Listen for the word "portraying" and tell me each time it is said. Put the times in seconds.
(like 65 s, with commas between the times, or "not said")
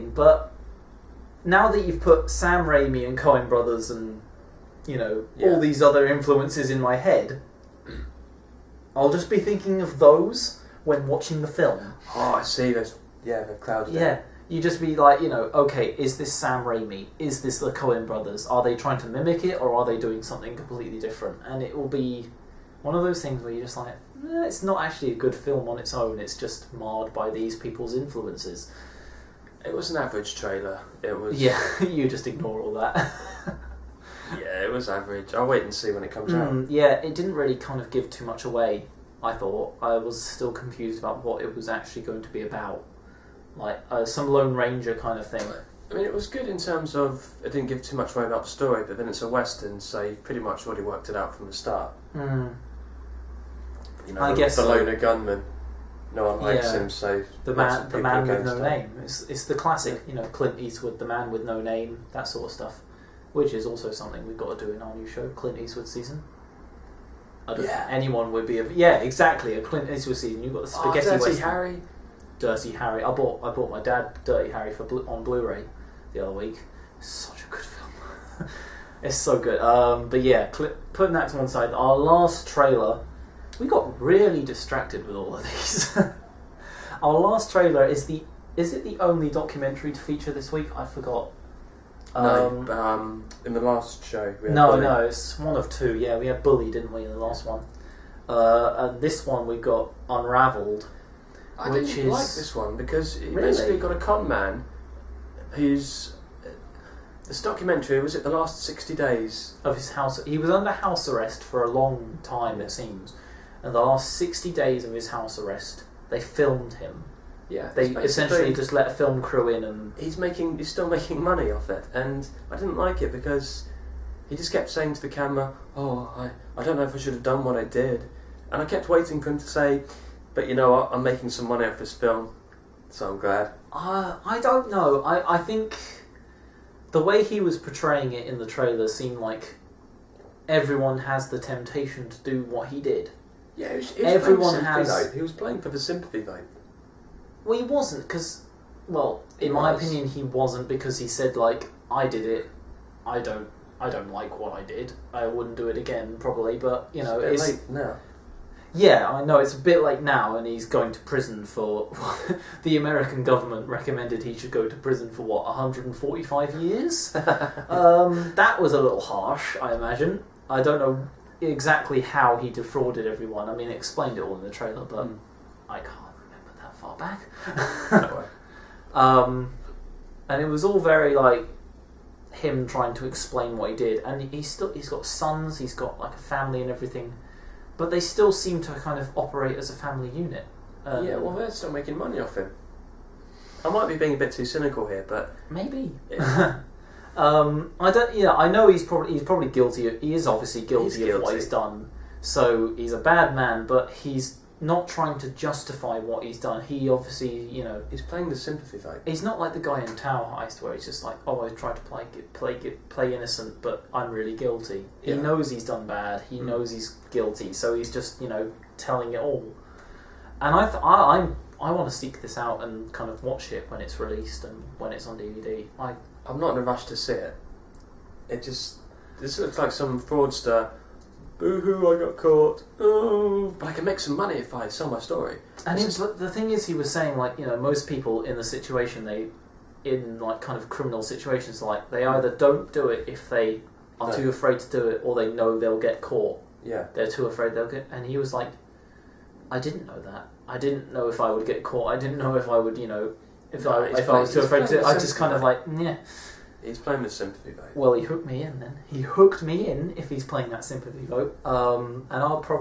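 137 s.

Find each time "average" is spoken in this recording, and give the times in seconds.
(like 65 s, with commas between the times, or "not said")
30 s, 34 s.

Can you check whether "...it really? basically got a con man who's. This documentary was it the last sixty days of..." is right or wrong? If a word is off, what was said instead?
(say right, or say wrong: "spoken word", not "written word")
right.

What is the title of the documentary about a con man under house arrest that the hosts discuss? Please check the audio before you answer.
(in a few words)
Unraveled.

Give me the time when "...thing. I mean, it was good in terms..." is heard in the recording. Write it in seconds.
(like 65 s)
45 s.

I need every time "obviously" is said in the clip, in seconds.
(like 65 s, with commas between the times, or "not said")
200 s, 206 s.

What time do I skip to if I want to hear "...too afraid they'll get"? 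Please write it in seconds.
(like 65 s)
247 s.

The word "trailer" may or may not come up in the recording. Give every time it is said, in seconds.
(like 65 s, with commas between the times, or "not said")
30 s, 82 s, 87 s, 138 s, 174 s.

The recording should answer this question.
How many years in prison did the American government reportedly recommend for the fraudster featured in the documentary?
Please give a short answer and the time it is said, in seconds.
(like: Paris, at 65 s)
145, at 165 s.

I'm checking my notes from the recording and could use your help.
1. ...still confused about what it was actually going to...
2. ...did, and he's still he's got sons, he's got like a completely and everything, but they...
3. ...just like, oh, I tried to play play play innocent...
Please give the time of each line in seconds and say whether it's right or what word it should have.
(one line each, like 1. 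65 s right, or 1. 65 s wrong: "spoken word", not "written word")
1. 40 s right
2. 183 s wrong: "family", not "completely"
3. 210 s right.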